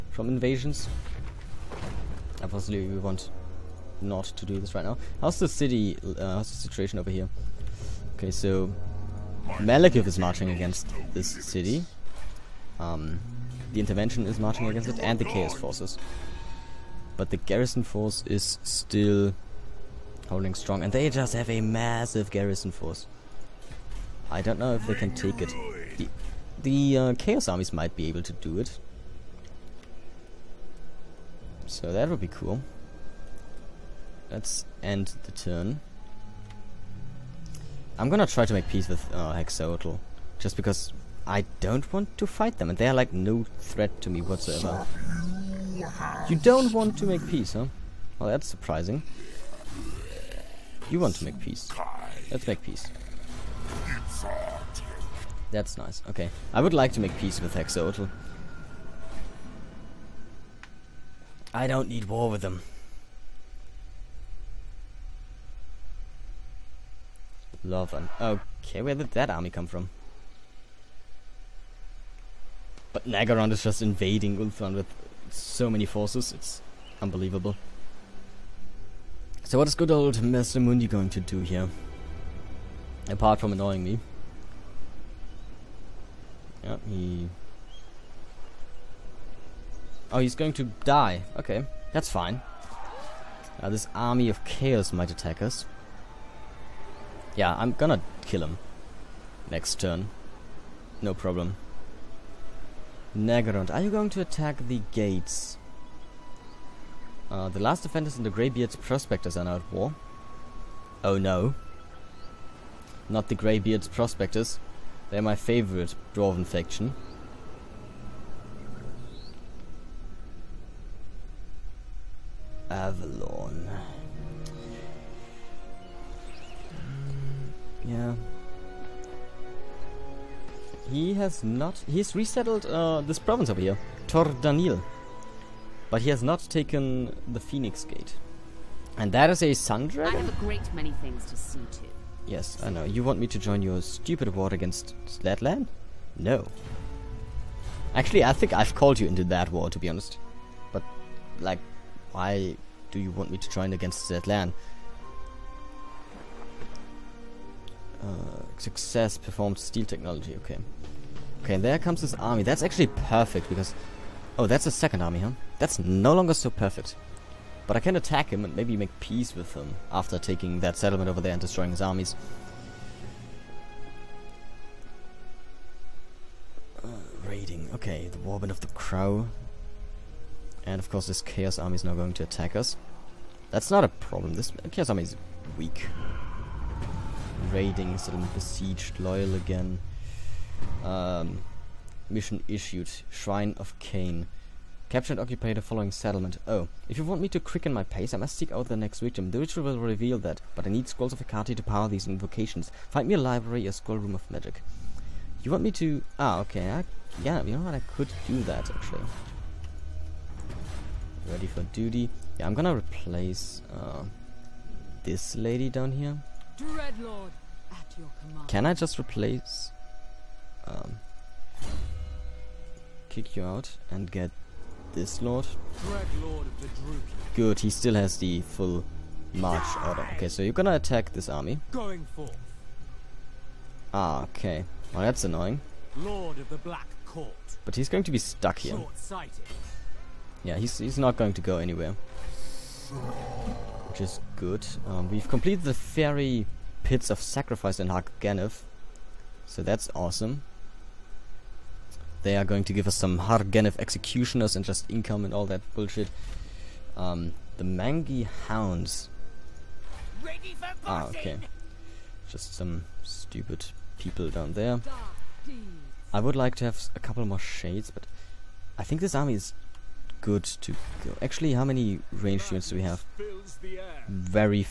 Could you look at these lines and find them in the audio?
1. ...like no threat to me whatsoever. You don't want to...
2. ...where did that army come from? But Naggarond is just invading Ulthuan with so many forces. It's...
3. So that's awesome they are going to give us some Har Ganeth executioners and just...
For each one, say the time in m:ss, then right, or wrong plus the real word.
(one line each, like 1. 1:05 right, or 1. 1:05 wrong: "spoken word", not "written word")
1. 0:42 right
2. 1:08 right
3. 4:09 right.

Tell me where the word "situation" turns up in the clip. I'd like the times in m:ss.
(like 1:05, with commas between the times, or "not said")
0:06.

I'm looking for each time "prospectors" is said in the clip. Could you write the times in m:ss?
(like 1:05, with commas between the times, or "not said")
1:48, 1:53.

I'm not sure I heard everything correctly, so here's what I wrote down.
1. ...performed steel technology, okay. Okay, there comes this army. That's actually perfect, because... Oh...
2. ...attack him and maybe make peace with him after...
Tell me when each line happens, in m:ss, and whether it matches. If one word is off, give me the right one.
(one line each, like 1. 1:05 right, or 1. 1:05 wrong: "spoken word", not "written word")
1. 2:39 right
2. 2:47 right.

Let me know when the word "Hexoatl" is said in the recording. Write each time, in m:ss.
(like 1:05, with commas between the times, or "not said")
0:39, 0:57.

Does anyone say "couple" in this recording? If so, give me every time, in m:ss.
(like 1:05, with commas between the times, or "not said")
4:26.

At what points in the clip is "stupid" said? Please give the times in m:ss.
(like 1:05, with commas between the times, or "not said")
2:23, 4:23.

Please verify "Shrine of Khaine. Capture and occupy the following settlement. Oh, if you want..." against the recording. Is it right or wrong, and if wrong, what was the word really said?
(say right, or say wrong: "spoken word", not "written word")
right.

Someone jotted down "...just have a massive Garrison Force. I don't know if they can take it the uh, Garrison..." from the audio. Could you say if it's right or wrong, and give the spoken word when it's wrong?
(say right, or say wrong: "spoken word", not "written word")
wrong: "Chaos", not "Garrison".